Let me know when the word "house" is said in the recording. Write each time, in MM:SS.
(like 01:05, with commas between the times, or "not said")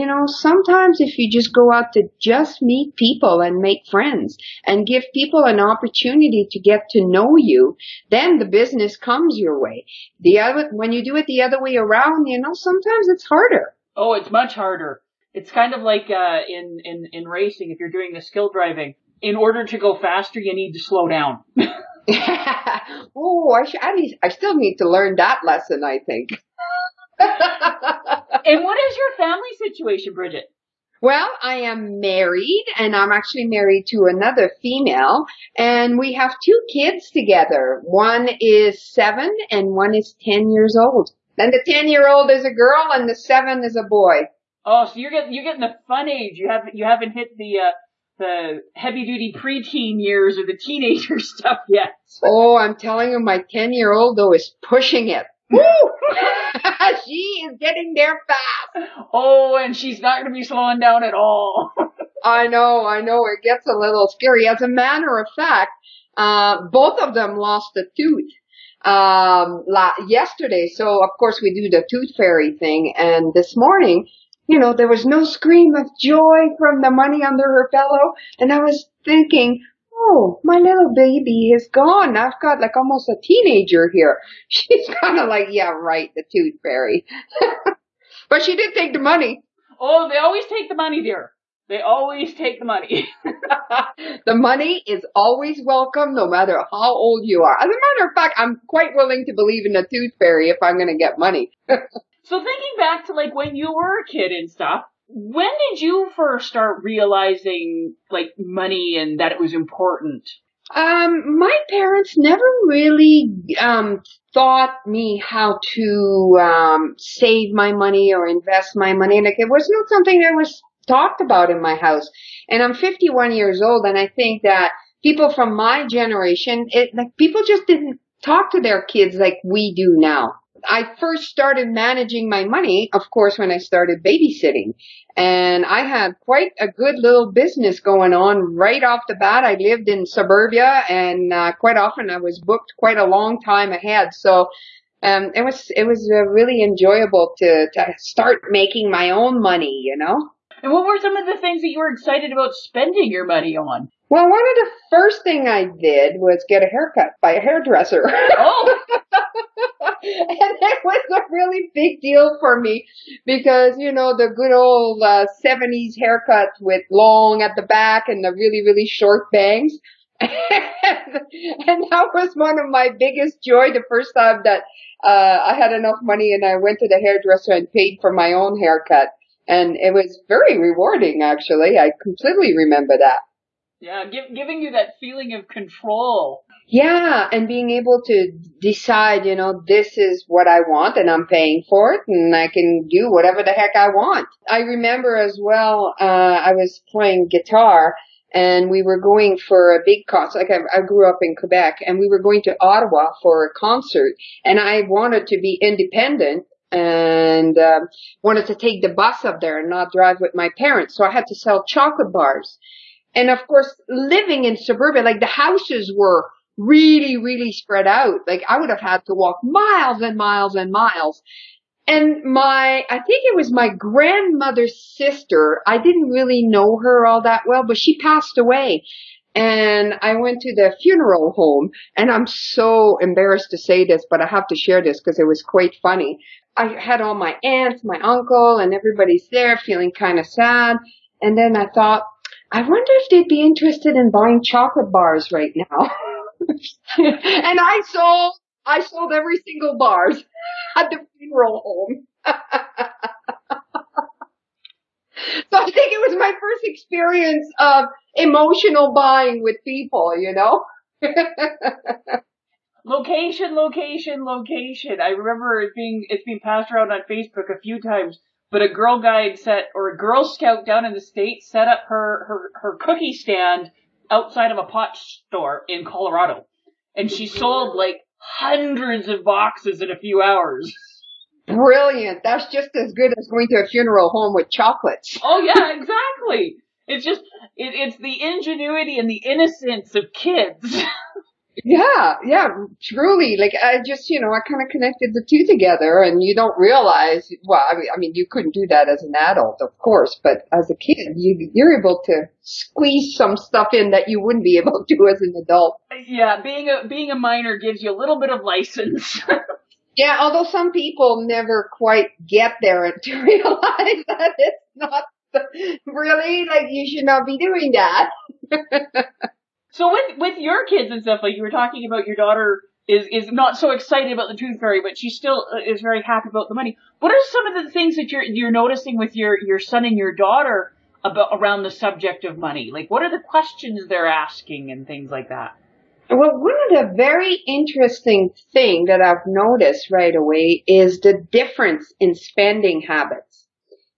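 02:01, 03:35.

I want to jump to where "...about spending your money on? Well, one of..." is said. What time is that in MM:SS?
02:32.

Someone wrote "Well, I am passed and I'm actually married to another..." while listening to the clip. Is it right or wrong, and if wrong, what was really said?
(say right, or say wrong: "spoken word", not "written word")
wrong: "married", not "passed".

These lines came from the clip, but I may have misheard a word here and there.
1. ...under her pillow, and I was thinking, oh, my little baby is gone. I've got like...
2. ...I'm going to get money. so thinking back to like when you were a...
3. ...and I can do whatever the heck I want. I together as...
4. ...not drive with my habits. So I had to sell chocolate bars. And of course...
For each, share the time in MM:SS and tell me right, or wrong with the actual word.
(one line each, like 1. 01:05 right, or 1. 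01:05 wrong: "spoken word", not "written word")
1. 01:17 right
2. 01:40 right
3. 03:12 wrong: "remember", not "together"
4. 03:29 wrong: "parents", not "habits".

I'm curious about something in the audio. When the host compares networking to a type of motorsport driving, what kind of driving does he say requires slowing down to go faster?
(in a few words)
skill driving.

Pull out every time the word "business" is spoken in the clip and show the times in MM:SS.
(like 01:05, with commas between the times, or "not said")
00:08, 02:17.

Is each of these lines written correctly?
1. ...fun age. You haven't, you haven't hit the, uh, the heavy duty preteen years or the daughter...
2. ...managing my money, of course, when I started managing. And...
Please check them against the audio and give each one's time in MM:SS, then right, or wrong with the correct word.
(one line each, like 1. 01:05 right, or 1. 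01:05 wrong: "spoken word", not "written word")
1. 00:45 wrong: "teenager", not "daughter"
2. 02:11 wrong: "babysitting", not "managing".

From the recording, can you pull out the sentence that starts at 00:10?
The other, when you do it the other way around, you know, sometimes it's harder.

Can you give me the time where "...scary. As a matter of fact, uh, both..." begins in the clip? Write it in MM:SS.
01:04.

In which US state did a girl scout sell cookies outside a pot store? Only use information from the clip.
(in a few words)
Colorado.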